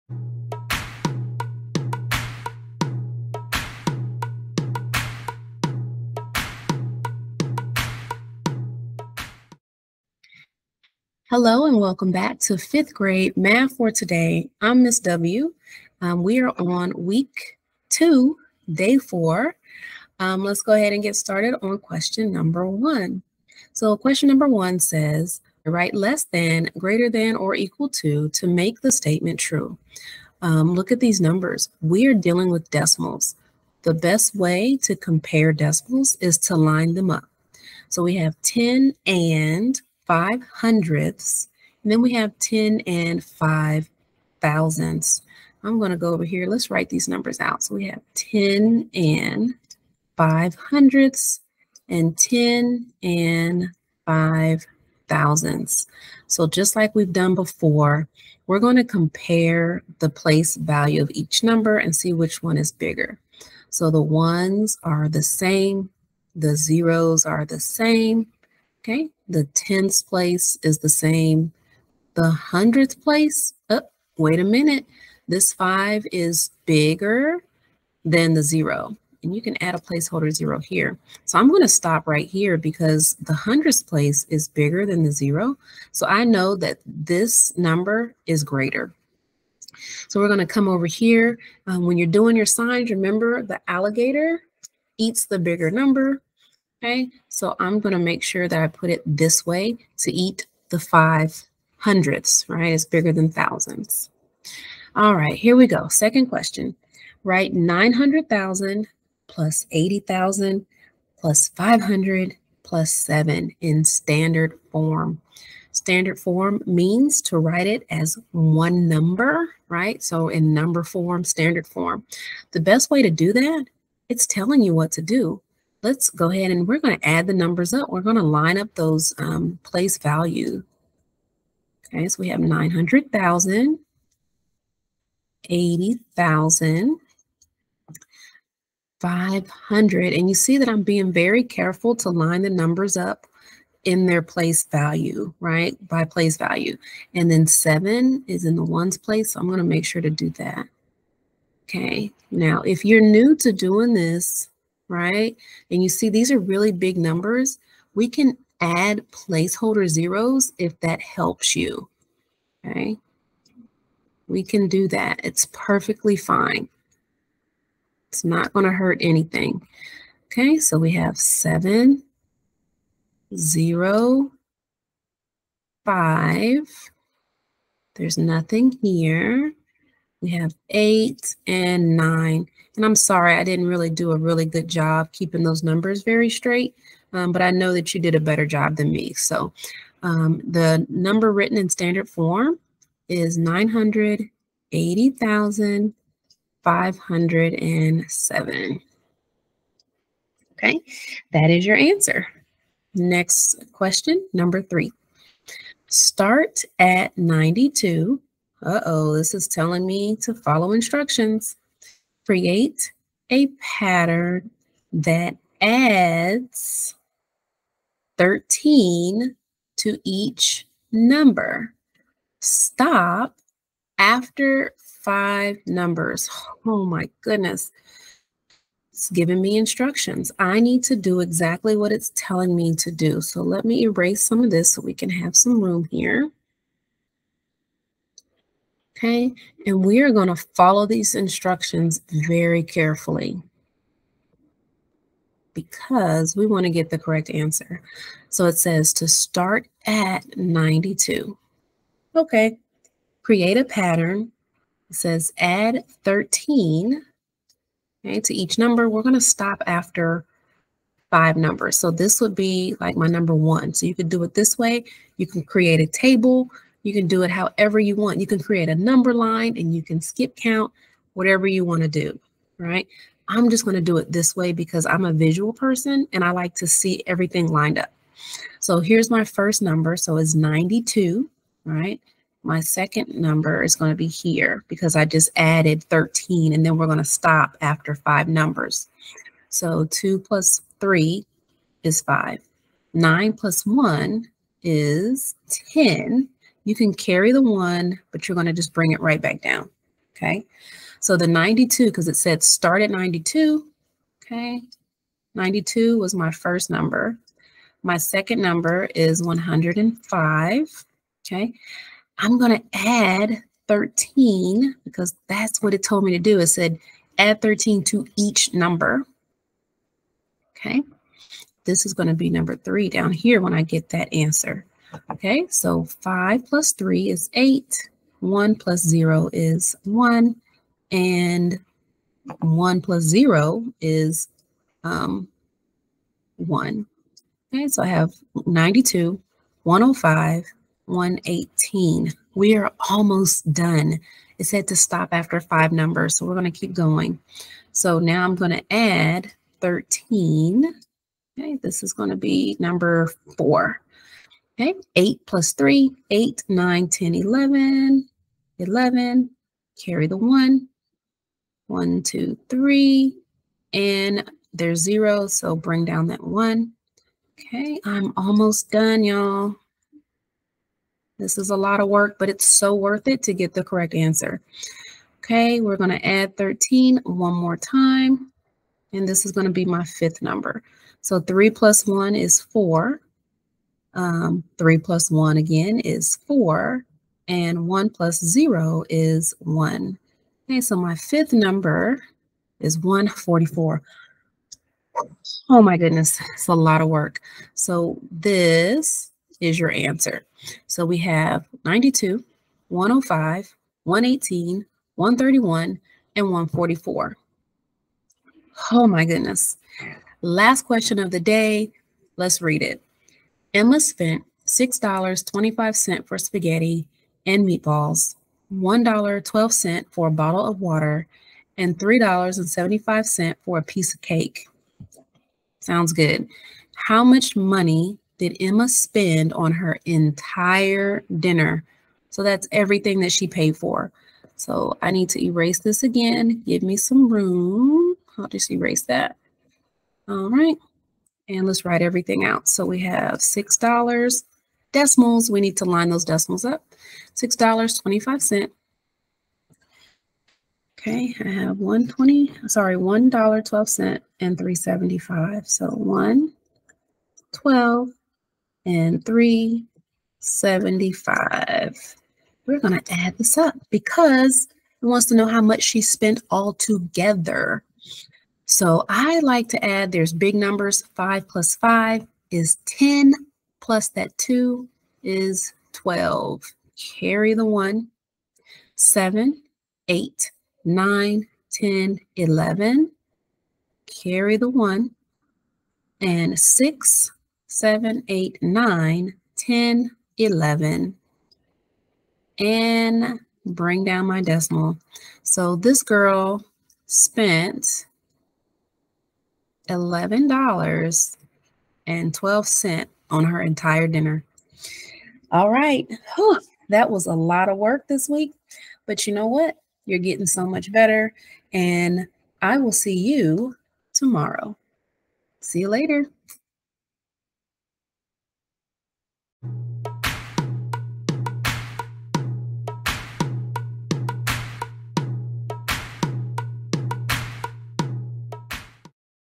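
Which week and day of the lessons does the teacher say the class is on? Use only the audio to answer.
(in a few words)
week two, day four.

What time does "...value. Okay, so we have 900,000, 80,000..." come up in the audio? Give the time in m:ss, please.
2:09.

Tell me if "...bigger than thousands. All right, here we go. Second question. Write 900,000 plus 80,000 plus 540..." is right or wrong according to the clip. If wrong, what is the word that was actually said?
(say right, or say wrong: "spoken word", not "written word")
wrong: "500", not "540".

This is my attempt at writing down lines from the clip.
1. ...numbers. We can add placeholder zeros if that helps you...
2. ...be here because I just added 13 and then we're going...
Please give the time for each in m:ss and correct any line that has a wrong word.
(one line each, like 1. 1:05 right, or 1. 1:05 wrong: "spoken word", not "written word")
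1. 2:36 right
2. 4:43 right.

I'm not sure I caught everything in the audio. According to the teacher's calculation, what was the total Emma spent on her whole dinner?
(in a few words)
$11.12.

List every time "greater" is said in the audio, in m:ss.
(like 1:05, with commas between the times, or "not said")
0:26, 1:28.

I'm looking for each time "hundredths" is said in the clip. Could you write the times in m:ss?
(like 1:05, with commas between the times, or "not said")
0:40, 0:50, 1:12, 1:23, 1:41.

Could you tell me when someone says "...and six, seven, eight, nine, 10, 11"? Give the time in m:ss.
8:06.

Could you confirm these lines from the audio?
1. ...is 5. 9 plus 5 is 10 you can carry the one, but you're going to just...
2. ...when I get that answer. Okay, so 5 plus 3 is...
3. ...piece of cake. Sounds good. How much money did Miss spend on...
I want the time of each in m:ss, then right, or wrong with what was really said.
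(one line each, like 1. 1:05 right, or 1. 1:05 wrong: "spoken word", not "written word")
1. 4:51 wrong: "1", not "5"
2. 5:23 right
3. 7:03 wrong: "Emma", not "Miss".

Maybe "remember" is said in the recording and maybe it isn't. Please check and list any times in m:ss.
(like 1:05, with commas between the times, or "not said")
1:32.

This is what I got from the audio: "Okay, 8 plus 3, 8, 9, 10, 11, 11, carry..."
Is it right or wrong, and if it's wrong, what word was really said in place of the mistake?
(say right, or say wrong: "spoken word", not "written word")
right.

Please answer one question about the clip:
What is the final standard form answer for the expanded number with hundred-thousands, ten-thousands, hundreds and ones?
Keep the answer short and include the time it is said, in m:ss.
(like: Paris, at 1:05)
980,507, at 3:13.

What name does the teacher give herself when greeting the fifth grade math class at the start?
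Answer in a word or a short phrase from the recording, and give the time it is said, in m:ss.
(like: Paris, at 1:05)
Miss W, at 0:14.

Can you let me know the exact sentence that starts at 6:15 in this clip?
Okay, we're going to add 13 one more time, and this is going to be my fifth number.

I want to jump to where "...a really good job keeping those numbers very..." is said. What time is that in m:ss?
3:04.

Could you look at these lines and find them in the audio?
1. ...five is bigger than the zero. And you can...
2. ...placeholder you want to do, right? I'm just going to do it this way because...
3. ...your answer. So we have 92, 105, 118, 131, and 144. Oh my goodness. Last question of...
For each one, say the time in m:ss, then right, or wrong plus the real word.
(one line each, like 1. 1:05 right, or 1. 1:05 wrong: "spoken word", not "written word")
1. 1:15 right
2. 4:31 wrong: "whatever", not "placeholder"
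3. 6:39 right.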